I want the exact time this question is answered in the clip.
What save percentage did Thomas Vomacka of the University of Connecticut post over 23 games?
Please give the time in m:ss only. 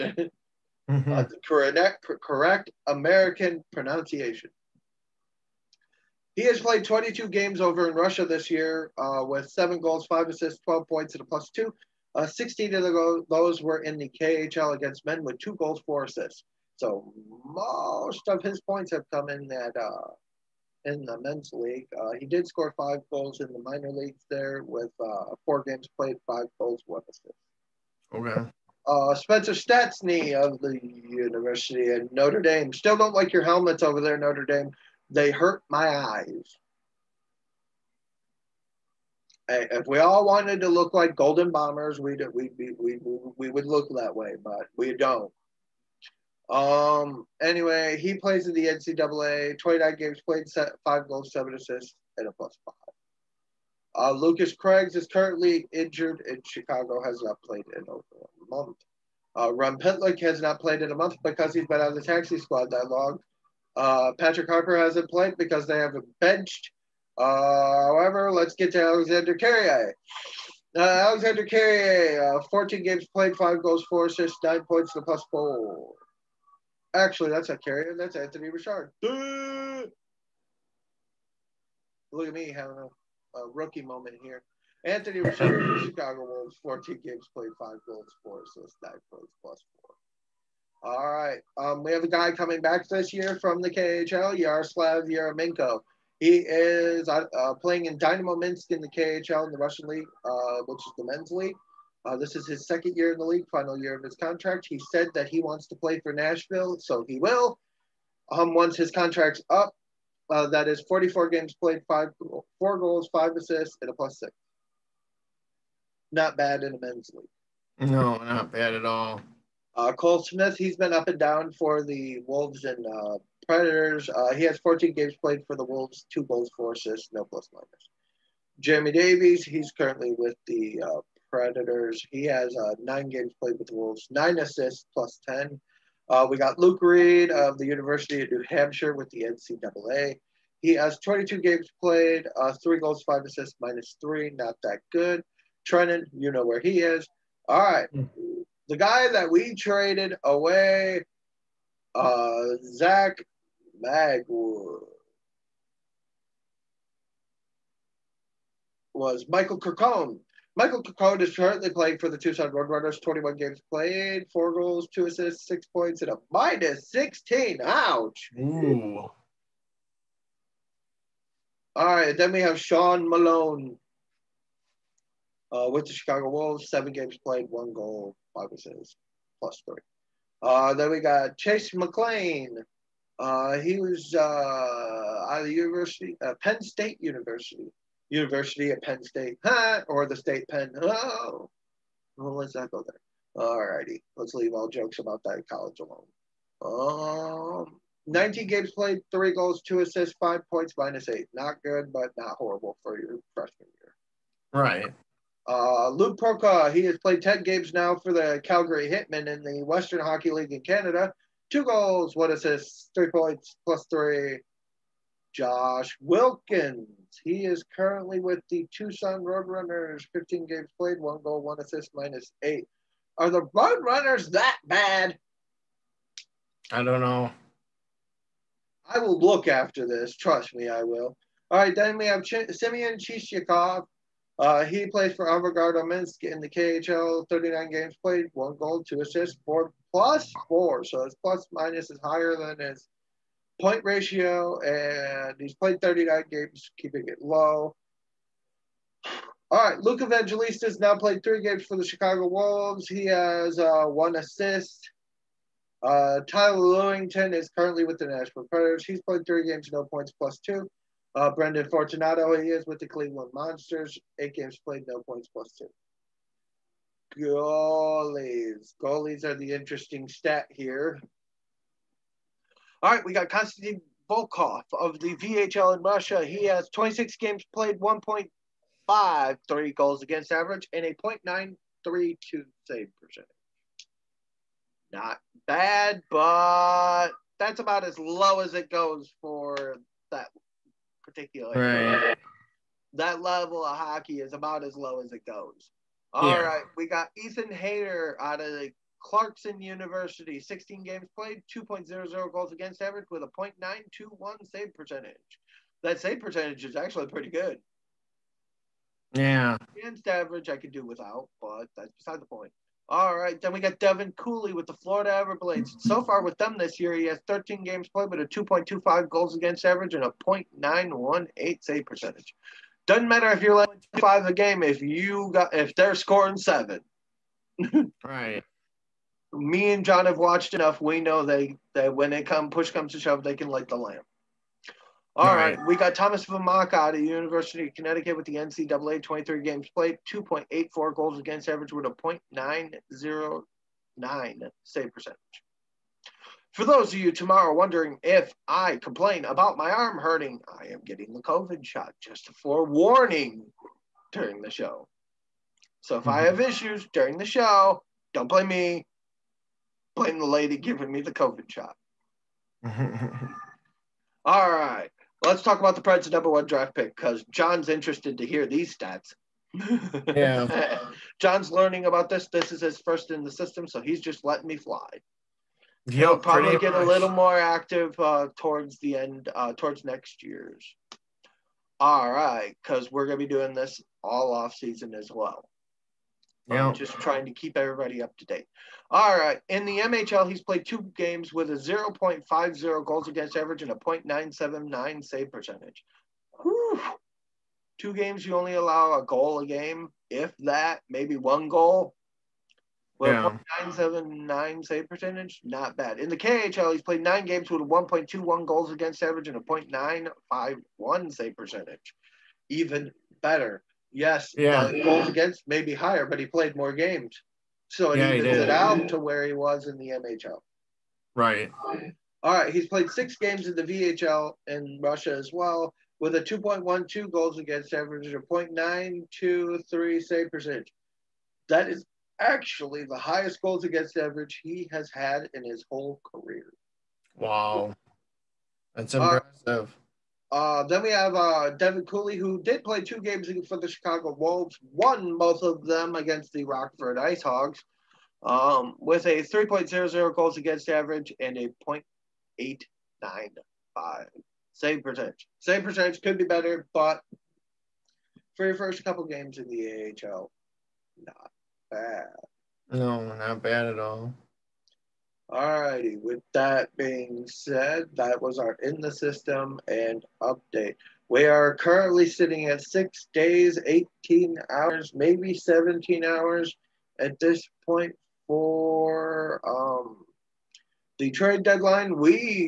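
5:42.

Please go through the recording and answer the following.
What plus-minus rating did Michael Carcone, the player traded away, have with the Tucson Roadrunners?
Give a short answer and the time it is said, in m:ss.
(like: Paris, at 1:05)
-16, at 2:46.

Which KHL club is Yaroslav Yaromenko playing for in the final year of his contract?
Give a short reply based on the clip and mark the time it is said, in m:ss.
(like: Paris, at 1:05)
Dynamo Minsk, at 1:37.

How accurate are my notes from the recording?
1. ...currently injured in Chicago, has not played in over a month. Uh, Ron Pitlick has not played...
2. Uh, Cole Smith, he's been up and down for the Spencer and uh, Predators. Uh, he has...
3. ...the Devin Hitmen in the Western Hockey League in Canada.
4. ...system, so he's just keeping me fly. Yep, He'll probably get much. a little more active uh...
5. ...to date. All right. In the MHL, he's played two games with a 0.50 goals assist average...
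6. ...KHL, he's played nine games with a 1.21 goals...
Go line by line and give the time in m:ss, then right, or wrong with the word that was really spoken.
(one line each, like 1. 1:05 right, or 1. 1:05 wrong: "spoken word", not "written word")
1. 0:55 right
2. 1:59 wrong: "Wolves", not "Spencer"
3. 3:28 wrong: "Calgary", not "Devin"
4. 6:13 wrong: "letting", not "keeping"
5. 6:28 wrong: "against", not "assist"
6. 6:46 right.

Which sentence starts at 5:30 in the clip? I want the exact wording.
We know they that when it come push comes to shove, they can light the lamp.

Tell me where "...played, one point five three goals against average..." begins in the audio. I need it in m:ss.
4:37.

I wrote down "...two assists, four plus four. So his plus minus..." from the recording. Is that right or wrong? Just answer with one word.
right.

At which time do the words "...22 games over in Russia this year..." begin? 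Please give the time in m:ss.
0:06.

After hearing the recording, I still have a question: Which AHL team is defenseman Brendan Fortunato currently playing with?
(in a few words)
Cleveland Monsters.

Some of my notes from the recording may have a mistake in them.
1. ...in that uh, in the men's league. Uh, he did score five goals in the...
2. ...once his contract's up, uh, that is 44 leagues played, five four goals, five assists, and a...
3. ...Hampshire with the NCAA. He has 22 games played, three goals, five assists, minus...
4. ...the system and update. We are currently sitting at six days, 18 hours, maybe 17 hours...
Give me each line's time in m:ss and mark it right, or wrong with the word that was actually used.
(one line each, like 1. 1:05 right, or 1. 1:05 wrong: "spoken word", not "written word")
1. 0:19 right
2. 1:48 wrong: "games", not "leagues"
3. 2:18 right
4. 7:48 right.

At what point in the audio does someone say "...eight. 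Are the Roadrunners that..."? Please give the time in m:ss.
3:42.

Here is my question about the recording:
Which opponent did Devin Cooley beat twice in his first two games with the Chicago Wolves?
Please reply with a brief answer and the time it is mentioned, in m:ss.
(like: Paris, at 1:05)
Rockford Ice Hogs, at 7:26.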